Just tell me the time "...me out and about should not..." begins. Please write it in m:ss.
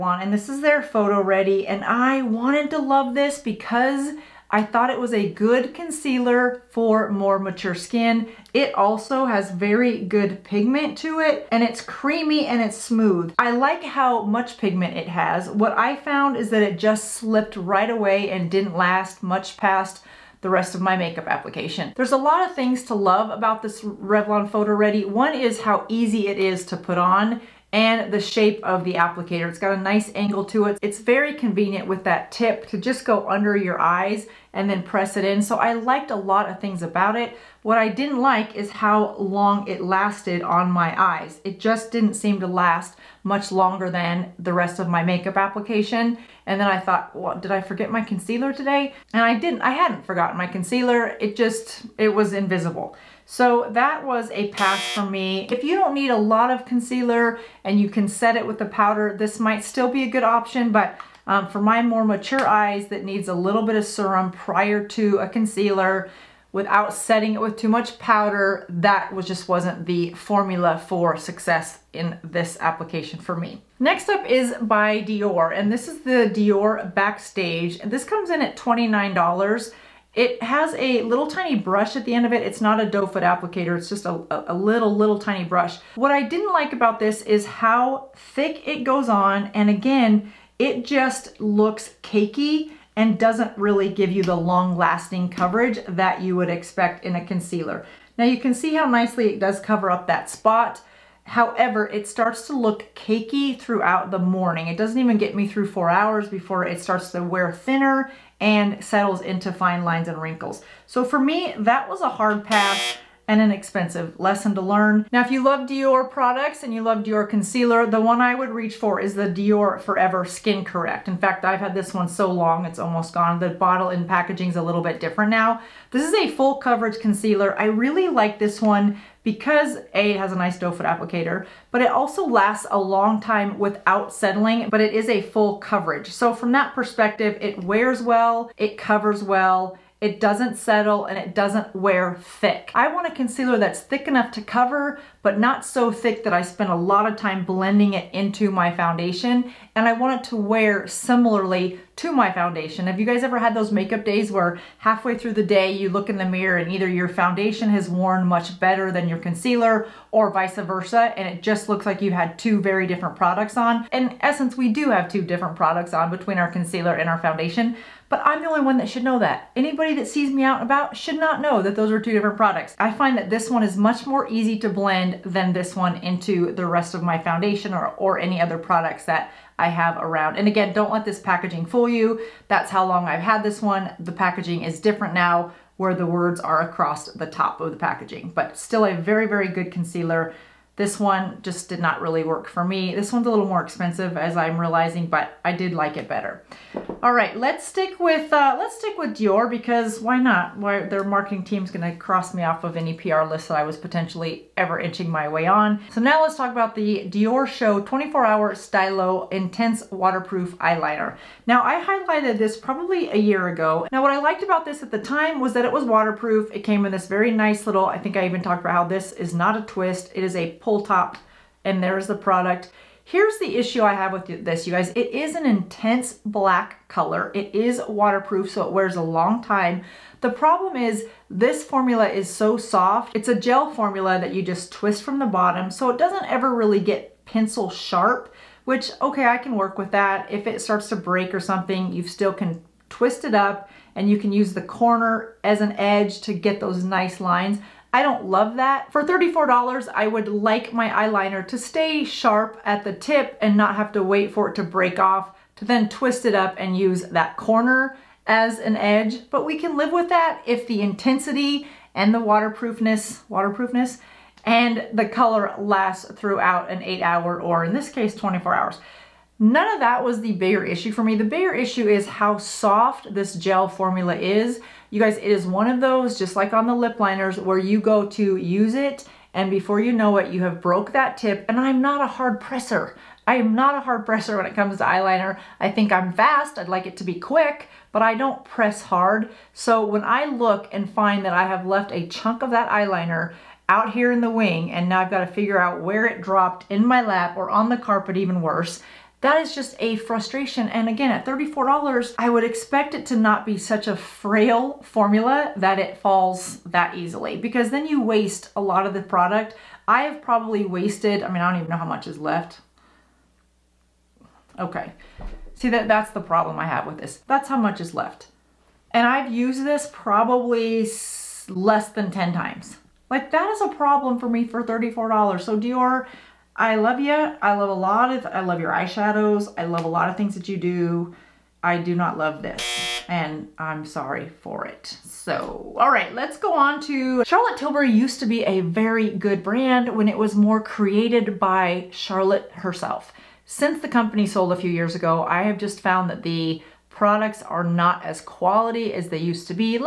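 2:50.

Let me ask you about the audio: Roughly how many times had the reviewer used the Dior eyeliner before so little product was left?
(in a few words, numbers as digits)
less than 10.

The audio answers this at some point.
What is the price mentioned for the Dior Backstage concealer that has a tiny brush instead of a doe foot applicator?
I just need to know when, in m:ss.
1:18.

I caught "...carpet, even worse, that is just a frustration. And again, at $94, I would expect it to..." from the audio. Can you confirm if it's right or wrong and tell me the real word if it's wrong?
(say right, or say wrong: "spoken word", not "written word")
wrong: "34", not "94".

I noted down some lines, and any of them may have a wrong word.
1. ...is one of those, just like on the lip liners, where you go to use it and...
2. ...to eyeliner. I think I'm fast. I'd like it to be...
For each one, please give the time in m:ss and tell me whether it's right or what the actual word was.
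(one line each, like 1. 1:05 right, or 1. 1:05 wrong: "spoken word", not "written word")
1. 4:35 right
2. 4:44 right.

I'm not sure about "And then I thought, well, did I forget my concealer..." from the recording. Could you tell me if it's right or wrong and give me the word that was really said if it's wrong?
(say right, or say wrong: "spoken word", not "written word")
right.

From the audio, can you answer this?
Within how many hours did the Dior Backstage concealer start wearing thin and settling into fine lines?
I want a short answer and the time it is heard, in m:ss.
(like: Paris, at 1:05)
4, at 1:45.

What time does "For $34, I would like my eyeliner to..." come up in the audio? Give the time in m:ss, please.
4:08.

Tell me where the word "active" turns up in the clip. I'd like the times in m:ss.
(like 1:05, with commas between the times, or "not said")
not said.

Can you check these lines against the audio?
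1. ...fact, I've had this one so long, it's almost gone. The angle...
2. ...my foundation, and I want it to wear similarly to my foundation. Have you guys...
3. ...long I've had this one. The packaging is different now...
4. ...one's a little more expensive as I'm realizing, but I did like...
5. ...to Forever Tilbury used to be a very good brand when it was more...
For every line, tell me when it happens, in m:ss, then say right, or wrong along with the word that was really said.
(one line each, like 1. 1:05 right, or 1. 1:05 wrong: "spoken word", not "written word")
1. 2:01 wrong: "bottle", not "angle"
2. 2:28 right
3. 3:02 right
4. 3:13 right
5. 5:36 wrong: "Charlotte", not "Forever".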